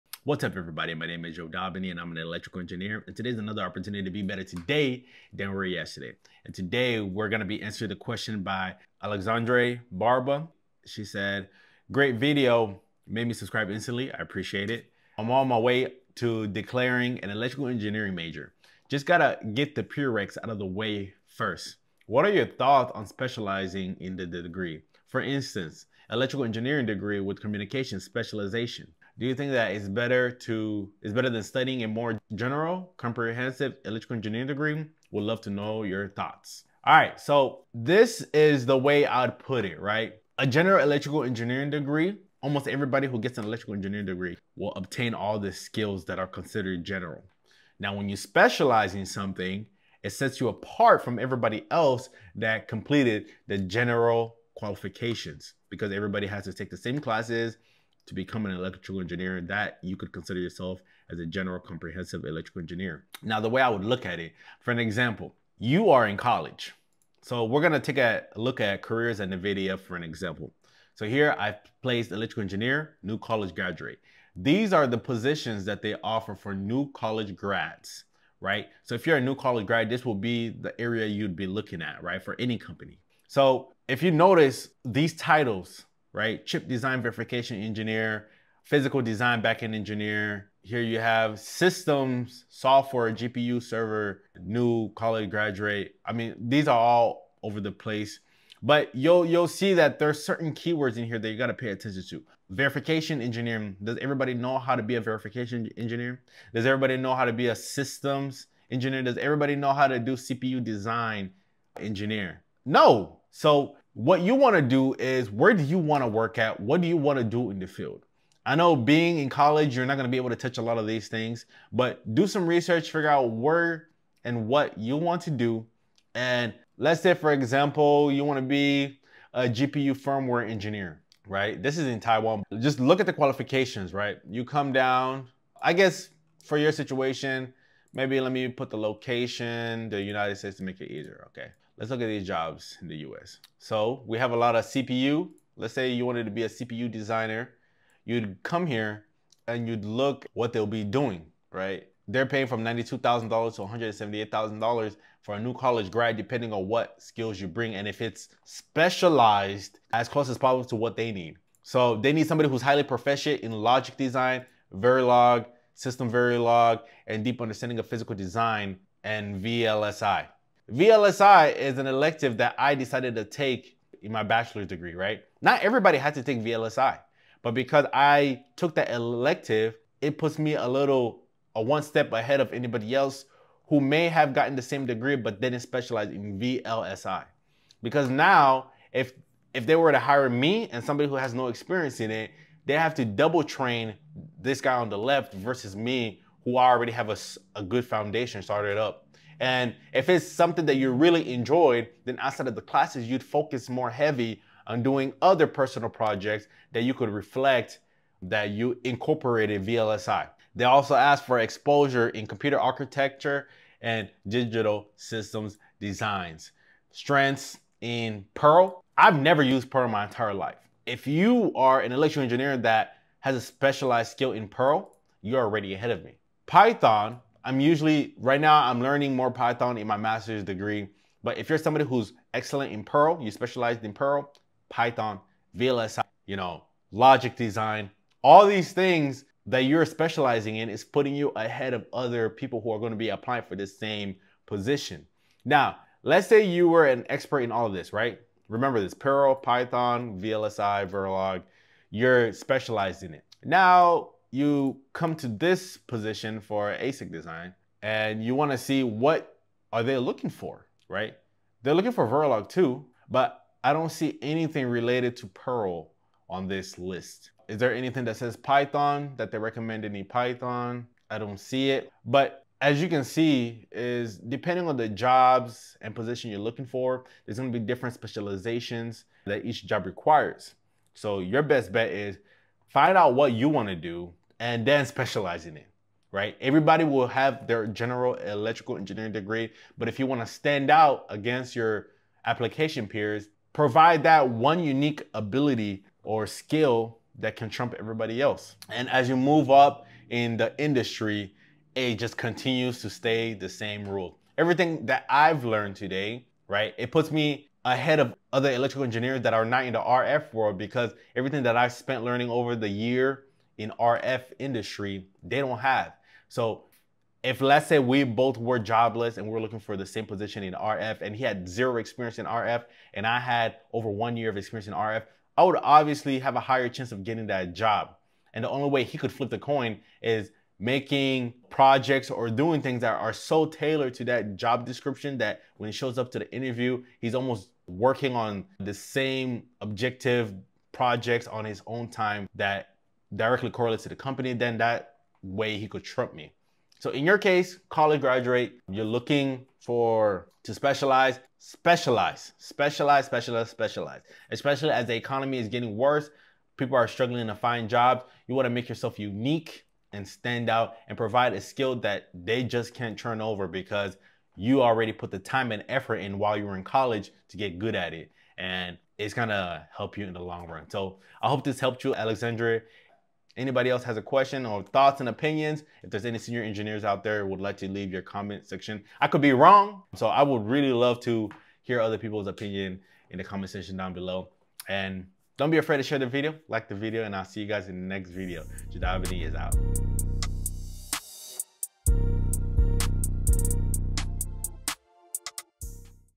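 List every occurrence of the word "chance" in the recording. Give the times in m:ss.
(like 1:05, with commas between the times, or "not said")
5:26.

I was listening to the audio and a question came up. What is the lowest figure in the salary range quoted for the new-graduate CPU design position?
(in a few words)
$92,000.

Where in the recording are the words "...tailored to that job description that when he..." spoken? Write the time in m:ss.
5:33.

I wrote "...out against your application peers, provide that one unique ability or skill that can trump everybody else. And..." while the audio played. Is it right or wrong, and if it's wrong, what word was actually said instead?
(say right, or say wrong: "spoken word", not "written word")
right.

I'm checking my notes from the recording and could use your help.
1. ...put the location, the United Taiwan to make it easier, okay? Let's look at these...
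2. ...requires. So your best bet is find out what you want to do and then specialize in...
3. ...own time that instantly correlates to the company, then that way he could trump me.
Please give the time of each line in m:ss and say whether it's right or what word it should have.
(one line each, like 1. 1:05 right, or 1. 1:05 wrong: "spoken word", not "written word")
1. 2:18 wrong: "States", not "Taiwan"
2. 4:39 right
3. 5:41 wrong: "directly", not "instantly".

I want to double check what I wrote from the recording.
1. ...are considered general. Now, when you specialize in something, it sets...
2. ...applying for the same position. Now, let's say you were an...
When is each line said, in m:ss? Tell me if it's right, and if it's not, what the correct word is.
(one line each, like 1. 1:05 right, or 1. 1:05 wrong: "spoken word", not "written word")
1. 0:46 right
2. 4:03 right.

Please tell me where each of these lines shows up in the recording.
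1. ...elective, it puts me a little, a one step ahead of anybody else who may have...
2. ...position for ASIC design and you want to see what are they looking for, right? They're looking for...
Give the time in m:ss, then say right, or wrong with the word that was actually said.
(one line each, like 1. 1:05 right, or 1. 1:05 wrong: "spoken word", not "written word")
1. 2:58 right
2. 4:15 right.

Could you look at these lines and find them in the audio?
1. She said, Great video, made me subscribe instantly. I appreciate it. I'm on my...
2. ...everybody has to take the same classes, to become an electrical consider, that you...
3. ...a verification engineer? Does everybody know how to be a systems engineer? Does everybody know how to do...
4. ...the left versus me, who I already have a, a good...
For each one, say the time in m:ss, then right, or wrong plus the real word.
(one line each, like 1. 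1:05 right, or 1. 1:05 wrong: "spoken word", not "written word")
1. 0:10 right
2. 0:55 wrong: "engineer", not "consider"
3. 1:44 right
4. 3:14 right.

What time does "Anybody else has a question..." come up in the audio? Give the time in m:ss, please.
6:13.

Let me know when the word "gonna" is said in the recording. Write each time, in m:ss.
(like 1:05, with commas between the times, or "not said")
1:07, 6:09.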